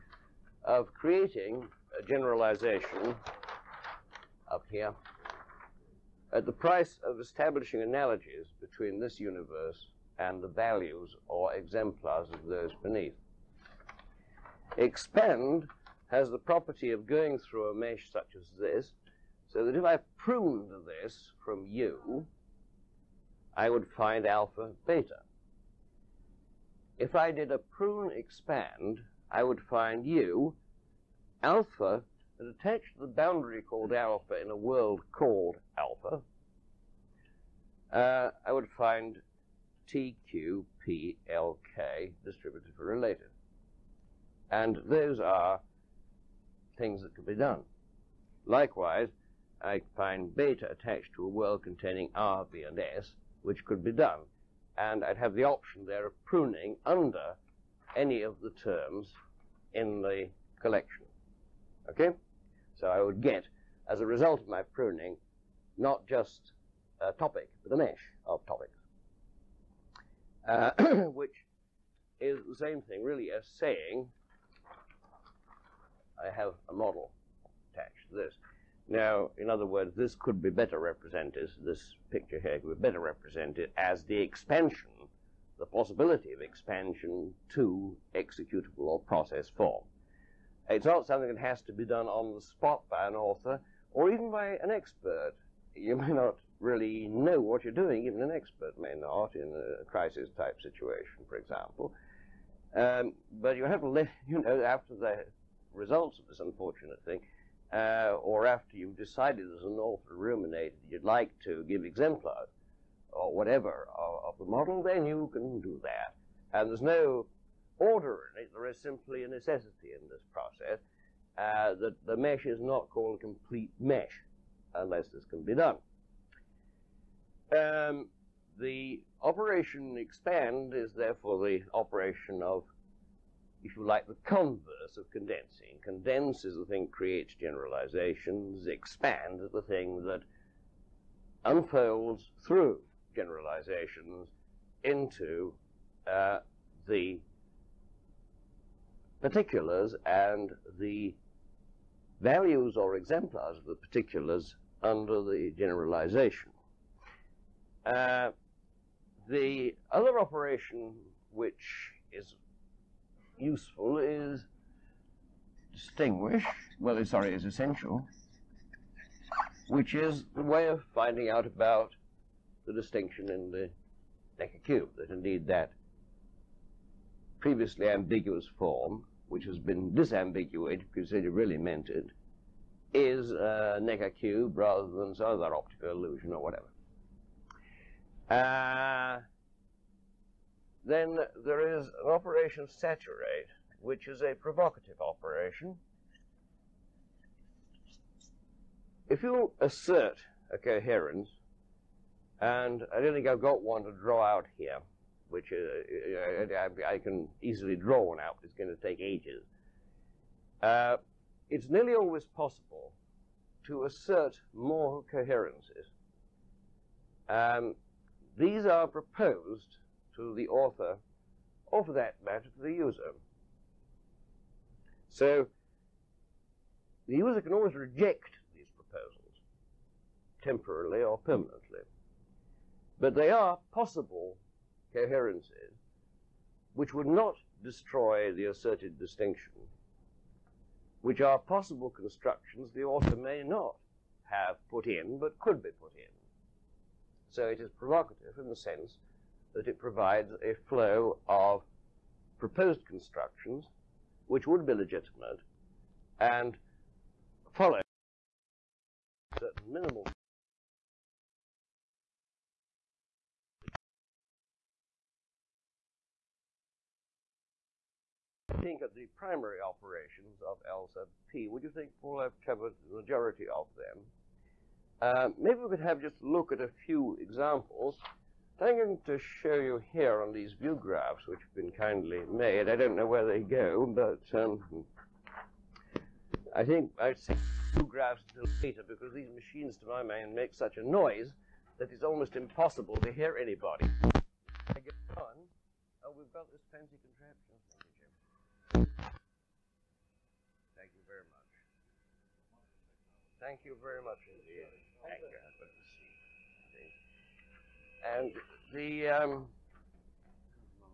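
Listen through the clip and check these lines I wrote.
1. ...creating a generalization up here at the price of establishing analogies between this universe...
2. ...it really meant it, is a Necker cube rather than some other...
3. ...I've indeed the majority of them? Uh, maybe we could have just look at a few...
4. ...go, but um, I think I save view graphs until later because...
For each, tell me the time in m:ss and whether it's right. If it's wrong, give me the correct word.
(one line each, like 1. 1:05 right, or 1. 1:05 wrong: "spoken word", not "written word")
1. 0:00 right
2. 3:01 right
3. 4:32 wrong: "covered", not "indeed"
4. 4:43 right.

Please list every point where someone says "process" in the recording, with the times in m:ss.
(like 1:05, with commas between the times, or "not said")
1:28, 2:00.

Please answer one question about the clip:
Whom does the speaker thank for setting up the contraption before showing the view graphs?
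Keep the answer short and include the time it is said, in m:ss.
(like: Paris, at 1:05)
Jim, at 4:57.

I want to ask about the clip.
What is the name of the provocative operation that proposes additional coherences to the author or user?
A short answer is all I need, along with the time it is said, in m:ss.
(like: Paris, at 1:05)
Saturate, at 3:12.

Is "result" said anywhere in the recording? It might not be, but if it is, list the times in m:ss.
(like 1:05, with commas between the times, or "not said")
1:04, 1:45.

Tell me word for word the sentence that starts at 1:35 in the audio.
You may not really know what you're doing, even an expert may not, in a crisis type situation, for example.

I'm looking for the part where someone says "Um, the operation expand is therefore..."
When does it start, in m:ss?
2:07.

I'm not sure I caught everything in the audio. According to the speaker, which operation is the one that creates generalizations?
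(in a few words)
Condense.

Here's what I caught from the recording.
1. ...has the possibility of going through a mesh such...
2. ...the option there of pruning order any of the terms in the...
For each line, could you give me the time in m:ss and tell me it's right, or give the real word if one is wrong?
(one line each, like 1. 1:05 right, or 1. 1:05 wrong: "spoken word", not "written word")
1. 0:16 wrong: "property", not "possibility"
2. 0:55 wrong: "under", not "order".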